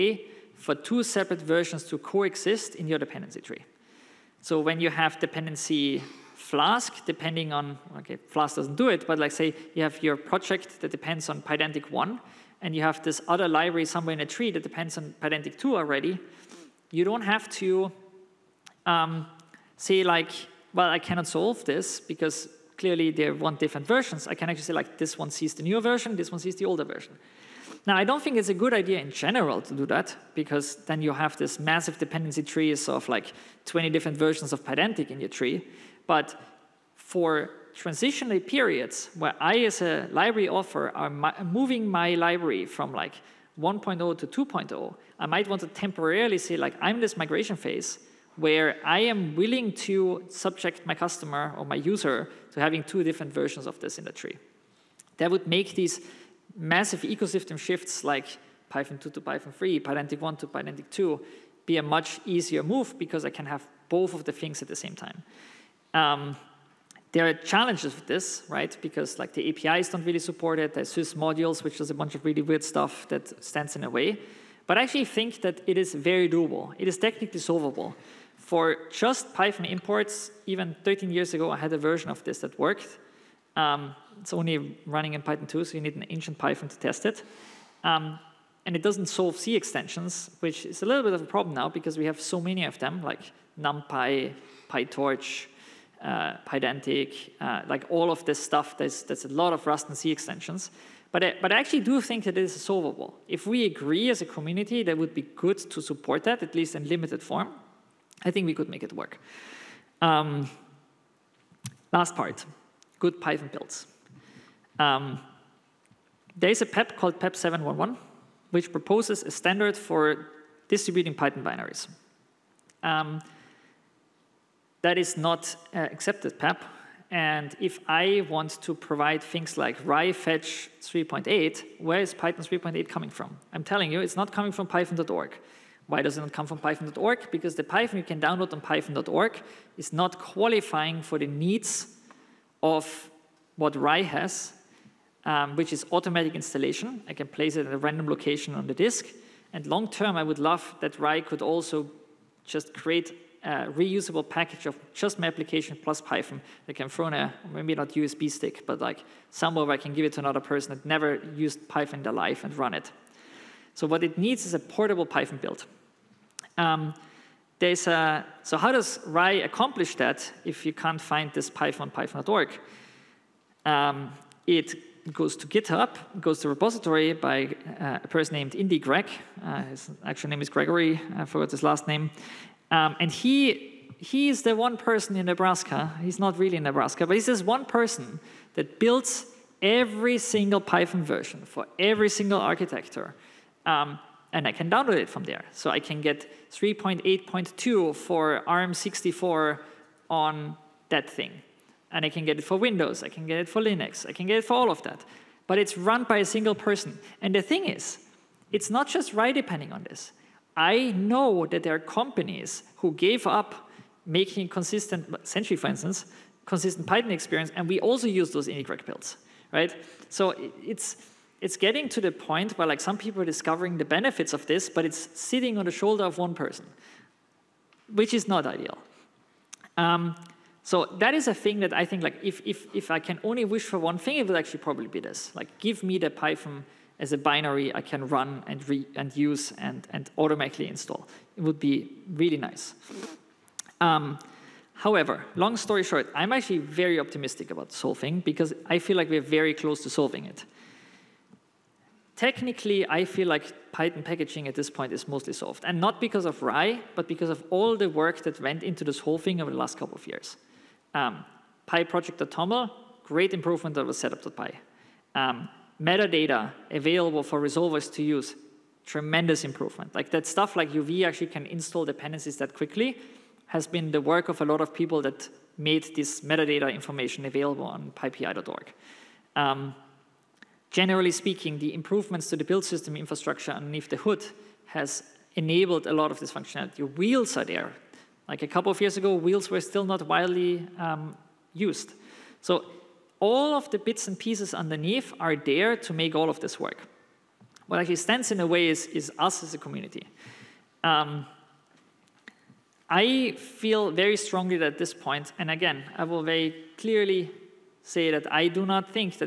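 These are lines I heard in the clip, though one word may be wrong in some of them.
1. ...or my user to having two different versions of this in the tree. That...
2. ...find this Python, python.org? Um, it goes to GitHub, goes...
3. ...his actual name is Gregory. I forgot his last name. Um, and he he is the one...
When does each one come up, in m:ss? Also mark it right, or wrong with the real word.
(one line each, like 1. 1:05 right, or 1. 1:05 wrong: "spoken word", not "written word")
1. 0:51 right
2. 2:51 right
3. 2:59 right.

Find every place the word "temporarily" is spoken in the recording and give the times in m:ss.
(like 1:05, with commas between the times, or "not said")
0:45.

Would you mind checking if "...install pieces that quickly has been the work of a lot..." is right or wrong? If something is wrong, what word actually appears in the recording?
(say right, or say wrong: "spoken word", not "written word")
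wrong: "dependencies", not "pieces".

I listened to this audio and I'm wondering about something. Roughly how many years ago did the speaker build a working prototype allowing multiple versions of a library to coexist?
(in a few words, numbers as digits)
13.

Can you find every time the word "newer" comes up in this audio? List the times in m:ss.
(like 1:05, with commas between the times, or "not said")
0:25.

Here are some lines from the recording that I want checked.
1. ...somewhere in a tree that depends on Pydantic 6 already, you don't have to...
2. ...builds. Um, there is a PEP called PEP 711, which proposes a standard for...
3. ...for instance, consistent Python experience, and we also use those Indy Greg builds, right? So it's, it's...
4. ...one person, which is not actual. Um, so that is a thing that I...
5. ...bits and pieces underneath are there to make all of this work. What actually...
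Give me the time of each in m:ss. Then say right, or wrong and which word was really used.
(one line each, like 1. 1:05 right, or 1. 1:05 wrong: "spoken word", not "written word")
1. 0:13 wrong: "2", not "6"
2. 1:53 right
3. 3:35 right
4. 3:46 wrong: "ideal", not "actual"
5. 4:53 right.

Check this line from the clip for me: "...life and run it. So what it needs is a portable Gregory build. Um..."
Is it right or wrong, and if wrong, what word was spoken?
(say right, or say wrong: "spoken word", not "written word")
wrong: "Python", not "Gregory".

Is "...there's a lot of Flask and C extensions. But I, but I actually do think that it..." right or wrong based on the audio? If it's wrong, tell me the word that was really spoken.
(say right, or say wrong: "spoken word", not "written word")
wrong: "Rust", not "Flask".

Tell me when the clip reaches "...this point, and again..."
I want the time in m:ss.
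5:04.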